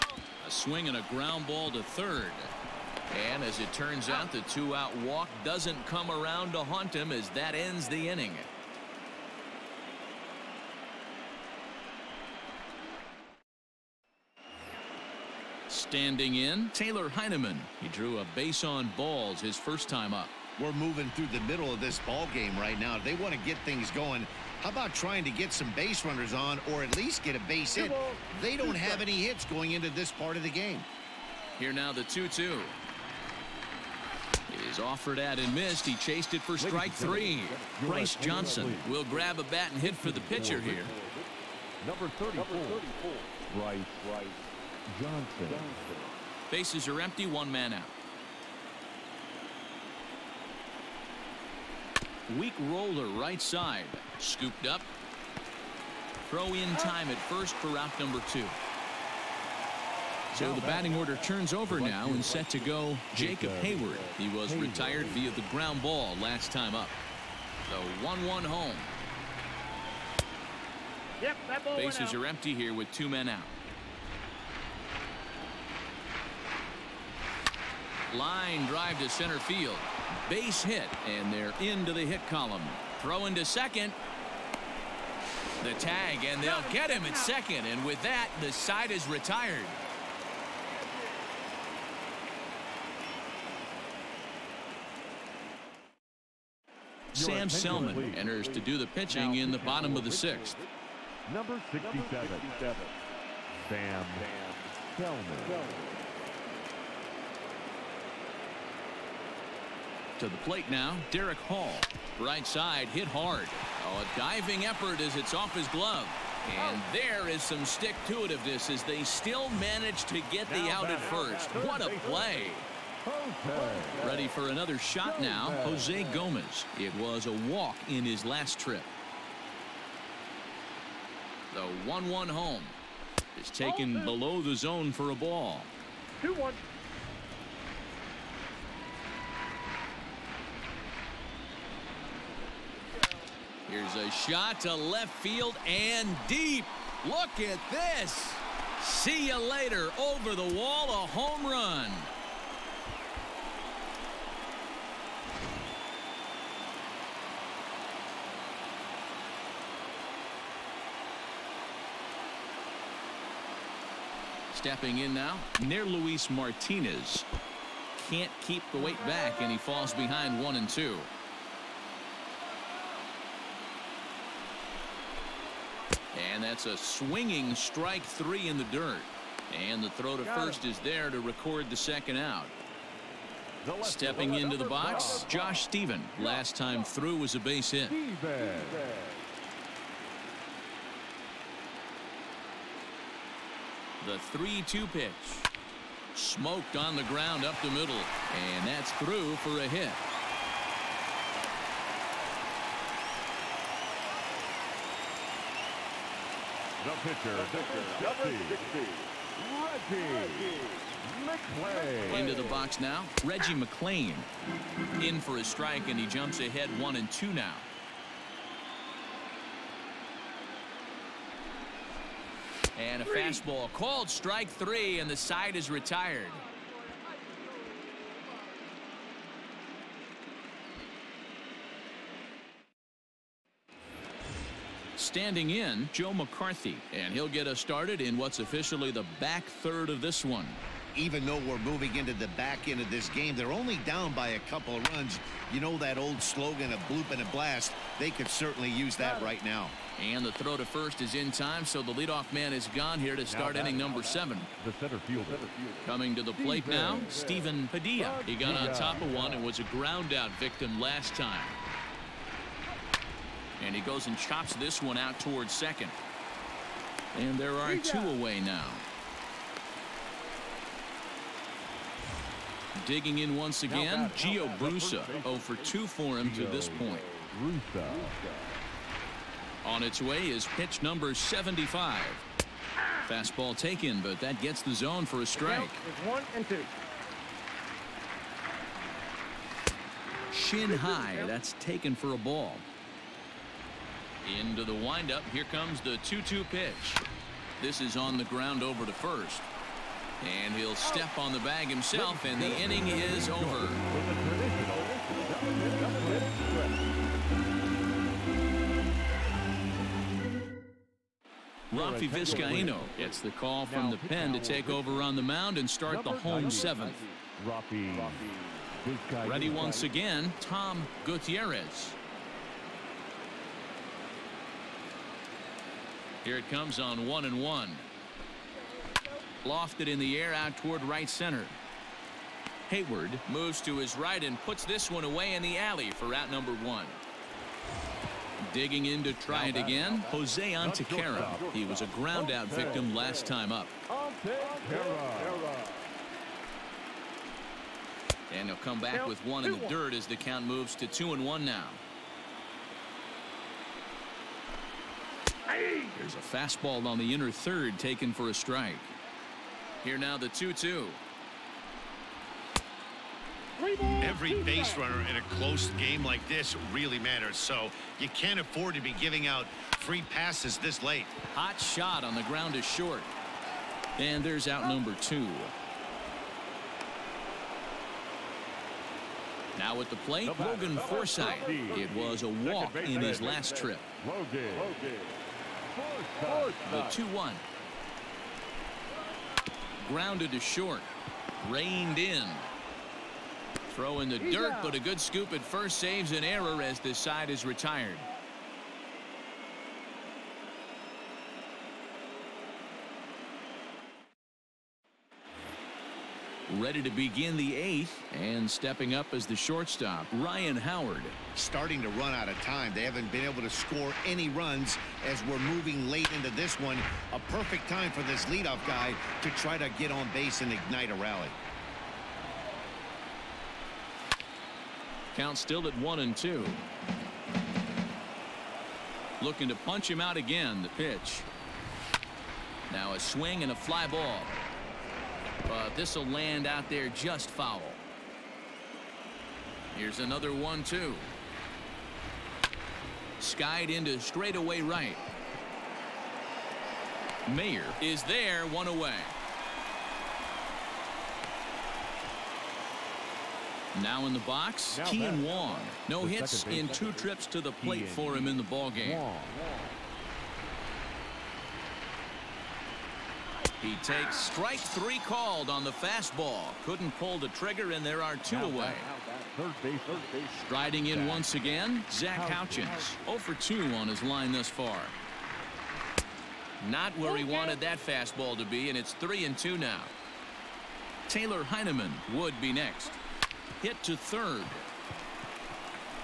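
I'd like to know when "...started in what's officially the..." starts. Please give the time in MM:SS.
03:57.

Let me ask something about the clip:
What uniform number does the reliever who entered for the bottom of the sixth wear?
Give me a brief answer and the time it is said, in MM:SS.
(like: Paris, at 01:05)
67, at 01:41.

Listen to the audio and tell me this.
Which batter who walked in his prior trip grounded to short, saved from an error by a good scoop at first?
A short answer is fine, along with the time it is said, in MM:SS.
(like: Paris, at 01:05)
Logan Forsythe, at 06:20.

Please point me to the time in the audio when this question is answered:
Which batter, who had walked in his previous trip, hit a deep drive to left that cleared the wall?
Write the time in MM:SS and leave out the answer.
02:05.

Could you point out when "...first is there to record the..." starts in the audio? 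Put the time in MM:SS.
03:00.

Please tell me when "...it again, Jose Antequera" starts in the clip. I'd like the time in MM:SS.
05:39.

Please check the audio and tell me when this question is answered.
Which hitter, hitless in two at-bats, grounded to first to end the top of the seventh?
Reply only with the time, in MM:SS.
04:34.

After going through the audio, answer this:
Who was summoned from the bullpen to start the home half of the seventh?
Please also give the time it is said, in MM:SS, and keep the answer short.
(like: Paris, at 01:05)
Rafi Vizcaino, at 05:11.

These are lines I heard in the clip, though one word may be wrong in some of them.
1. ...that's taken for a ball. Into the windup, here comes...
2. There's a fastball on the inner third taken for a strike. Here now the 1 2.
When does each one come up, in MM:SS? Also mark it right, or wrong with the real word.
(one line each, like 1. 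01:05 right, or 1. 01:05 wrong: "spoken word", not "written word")
1. 04:51 right
2. 05:55 wrong: "2", not "1".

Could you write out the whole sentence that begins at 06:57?
A perfect time for this leadoff guy to try to get on base and ignite a rally.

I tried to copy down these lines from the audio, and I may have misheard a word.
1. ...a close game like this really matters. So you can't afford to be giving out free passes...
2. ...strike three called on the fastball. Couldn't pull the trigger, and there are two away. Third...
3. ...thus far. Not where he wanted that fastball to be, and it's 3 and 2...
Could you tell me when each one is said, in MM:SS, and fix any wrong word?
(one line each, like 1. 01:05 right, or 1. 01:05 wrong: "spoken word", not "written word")
1. 06:05 right
2. 07:44 right
3. 07:54 right.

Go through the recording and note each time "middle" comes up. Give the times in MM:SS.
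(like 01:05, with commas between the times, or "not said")
00:21, 03:17.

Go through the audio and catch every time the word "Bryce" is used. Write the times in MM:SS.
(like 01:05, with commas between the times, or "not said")
00:37, 00:43.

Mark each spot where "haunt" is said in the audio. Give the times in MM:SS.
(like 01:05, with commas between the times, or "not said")
00:06.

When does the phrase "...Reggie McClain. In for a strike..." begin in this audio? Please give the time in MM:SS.
03:33.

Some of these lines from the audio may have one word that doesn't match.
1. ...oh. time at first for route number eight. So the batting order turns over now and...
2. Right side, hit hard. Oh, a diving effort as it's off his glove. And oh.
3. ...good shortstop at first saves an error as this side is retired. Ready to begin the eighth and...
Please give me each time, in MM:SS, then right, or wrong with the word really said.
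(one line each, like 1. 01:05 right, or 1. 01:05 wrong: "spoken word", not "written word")
1. 00:56 wrong: "two", not "eight"
2. 01:52 right
3. 06:34 wrong: "scoop", not "shortstop".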